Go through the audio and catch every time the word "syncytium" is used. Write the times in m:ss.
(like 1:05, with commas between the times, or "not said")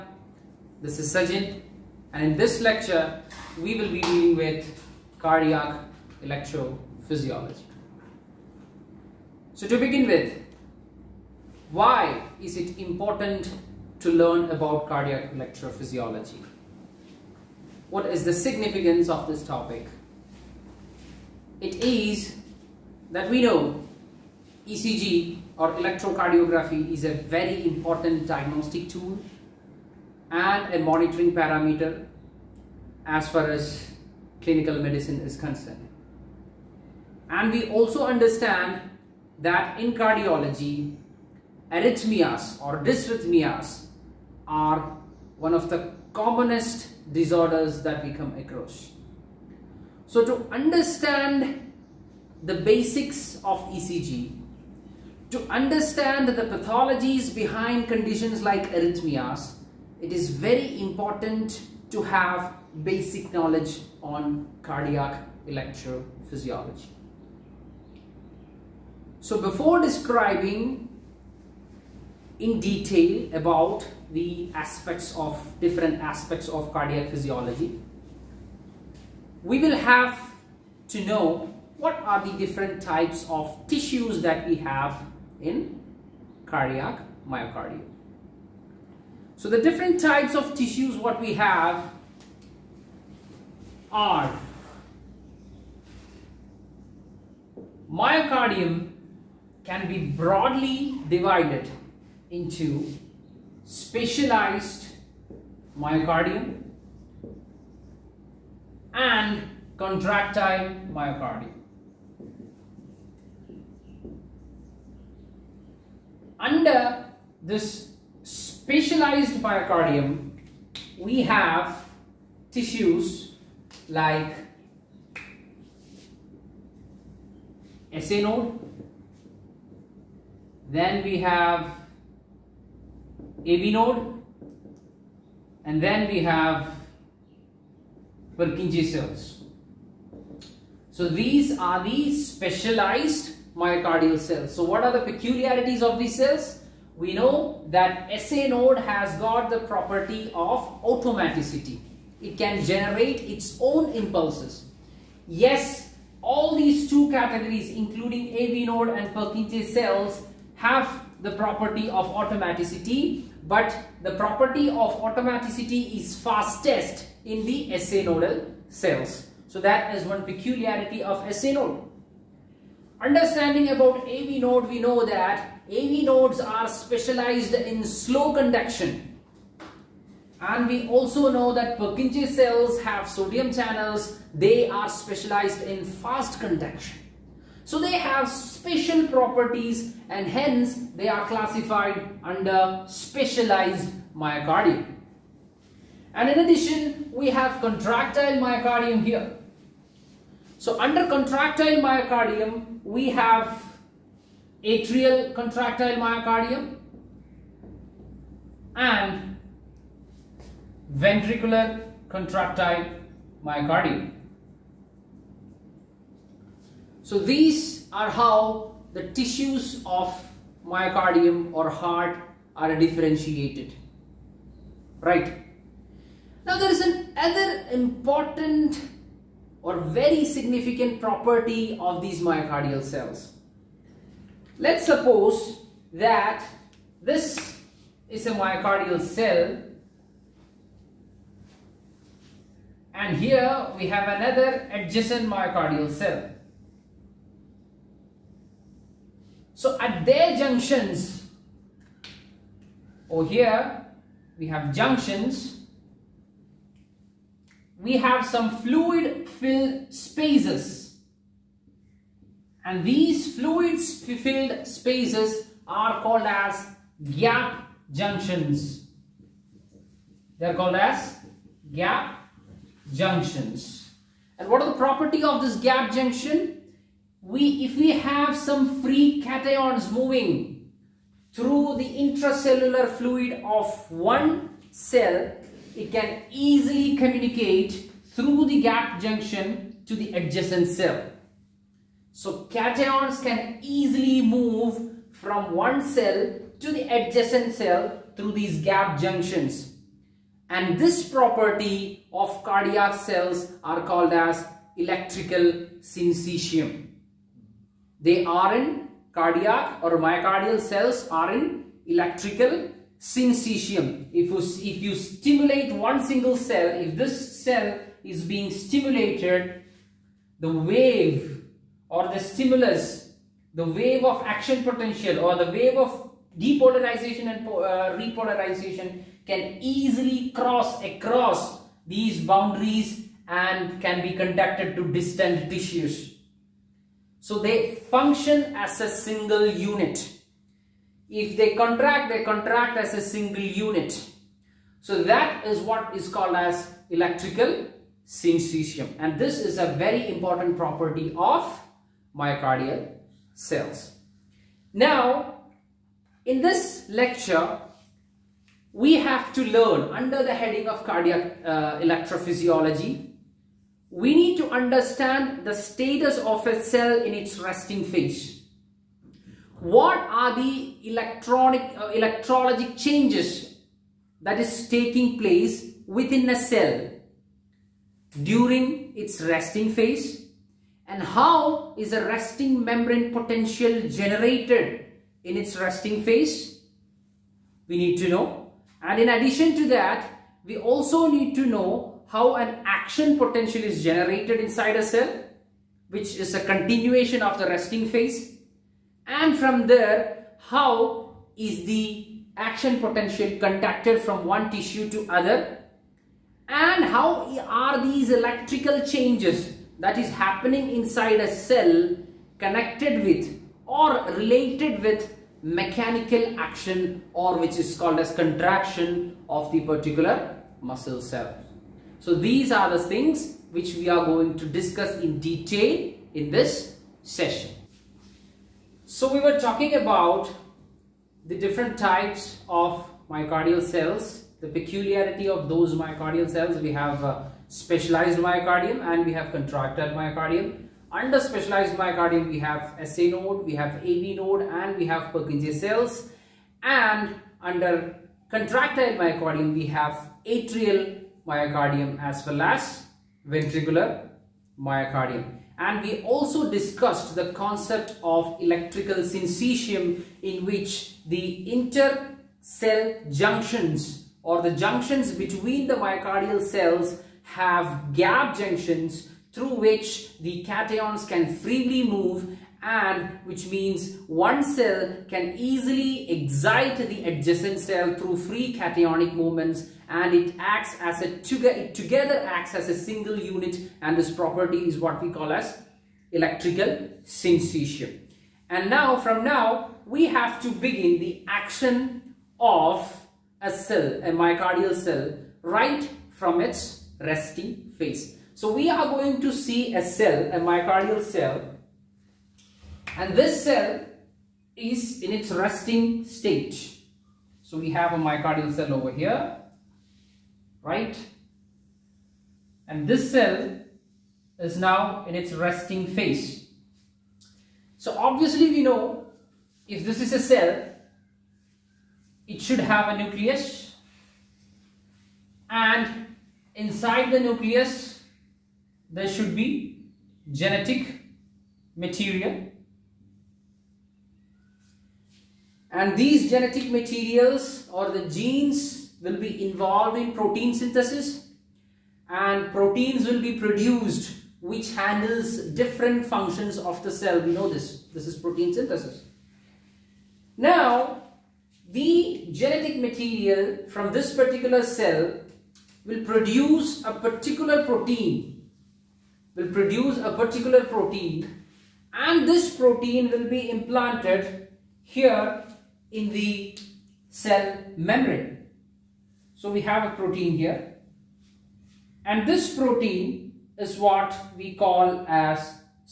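5:05, 5:13, 5:48, 7:39, 8:07.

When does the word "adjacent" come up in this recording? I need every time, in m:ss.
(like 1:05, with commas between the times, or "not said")
4:04, 4:50, 4:56, 7:57.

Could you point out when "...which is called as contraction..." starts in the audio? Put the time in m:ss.
6:57.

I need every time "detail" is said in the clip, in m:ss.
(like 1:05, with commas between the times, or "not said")
1:12, 7:05.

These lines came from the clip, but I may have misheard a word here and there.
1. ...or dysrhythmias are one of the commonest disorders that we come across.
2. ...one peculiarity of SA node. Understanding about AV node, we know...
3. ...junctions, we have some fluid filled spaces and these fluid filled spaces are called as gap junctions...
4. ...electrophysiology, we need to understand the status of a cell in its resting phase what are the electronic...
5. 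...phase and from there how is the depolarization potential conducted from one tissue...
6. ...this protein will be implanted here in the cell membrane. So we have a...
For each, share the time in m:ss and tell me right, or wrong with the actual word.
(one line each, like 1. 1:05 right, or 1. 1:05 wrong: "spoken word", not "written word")
1. 0:42 right
2. 2:50 right
3. 4:14 right
4. 6:01 right
5. 6:37 wrong: "action", not "depolarization"
6. 9:22 right.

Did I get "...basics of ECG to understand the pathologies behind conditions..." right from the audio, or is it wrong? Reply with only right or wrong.
right.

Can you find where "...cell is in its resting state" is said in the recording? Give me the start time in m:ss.
8:23.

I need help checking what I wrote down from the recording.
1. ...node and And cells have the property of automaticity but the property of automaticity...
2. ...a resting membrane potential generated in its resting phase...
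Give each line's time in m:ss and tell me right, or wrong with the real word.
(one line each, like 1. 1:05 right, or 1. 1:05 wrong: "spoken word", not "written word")
1. 2:38 wrong: "Purkinje", not "And"
2. 6:21 right.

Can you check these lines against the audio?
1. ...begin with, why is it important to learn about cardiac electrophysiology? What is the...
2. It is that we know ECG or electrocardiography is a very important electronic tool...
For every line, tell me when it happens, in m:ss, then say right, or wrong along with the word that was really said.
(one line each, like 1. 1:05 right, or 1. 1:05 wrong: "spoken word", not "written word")
1. 0:09 right
2. 0:21 wrong: "diagnostic", not "electronic".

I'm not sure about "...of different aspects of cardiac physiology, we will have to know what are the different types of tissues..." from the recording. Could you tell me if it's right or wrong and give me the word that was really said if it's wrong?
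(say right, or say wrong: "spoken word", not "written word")
right.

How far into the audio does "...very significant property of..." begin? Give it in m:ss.
3:49.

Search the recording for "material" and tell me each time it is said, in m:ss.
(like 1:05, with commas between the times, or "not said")
8:51, 8:56, 9:12.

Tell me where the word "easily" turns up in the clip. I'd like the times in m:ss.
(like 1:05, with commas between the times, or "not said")
4:46, 4:53, 5:29, 7:55.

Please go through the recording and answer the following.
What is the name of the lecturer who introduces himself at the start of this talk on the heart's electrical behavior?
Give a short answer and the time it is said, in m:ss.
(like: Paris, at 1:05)
Sajin, at 0:01.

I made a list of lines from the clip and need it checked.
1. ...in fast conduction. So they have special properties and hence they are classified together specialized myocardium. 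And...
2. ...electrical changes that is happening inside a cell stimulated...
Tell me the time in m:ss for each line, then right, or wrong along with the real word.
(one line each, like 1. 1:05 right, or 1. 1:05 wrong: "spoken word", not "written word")
1. 3:05 wrong: "under", not "together"
2. 6:48 wrong: "connected", not "stimulated".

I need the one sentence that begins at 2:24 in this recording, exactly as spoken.
So what are the peculiarities of these cells?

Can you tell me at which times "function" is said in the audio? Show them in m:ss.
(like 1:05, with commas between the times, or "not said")
5:37, 9:06.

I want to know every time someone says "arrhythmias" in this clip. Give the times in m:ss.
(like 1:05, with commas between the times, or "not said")
0:41, 0:58.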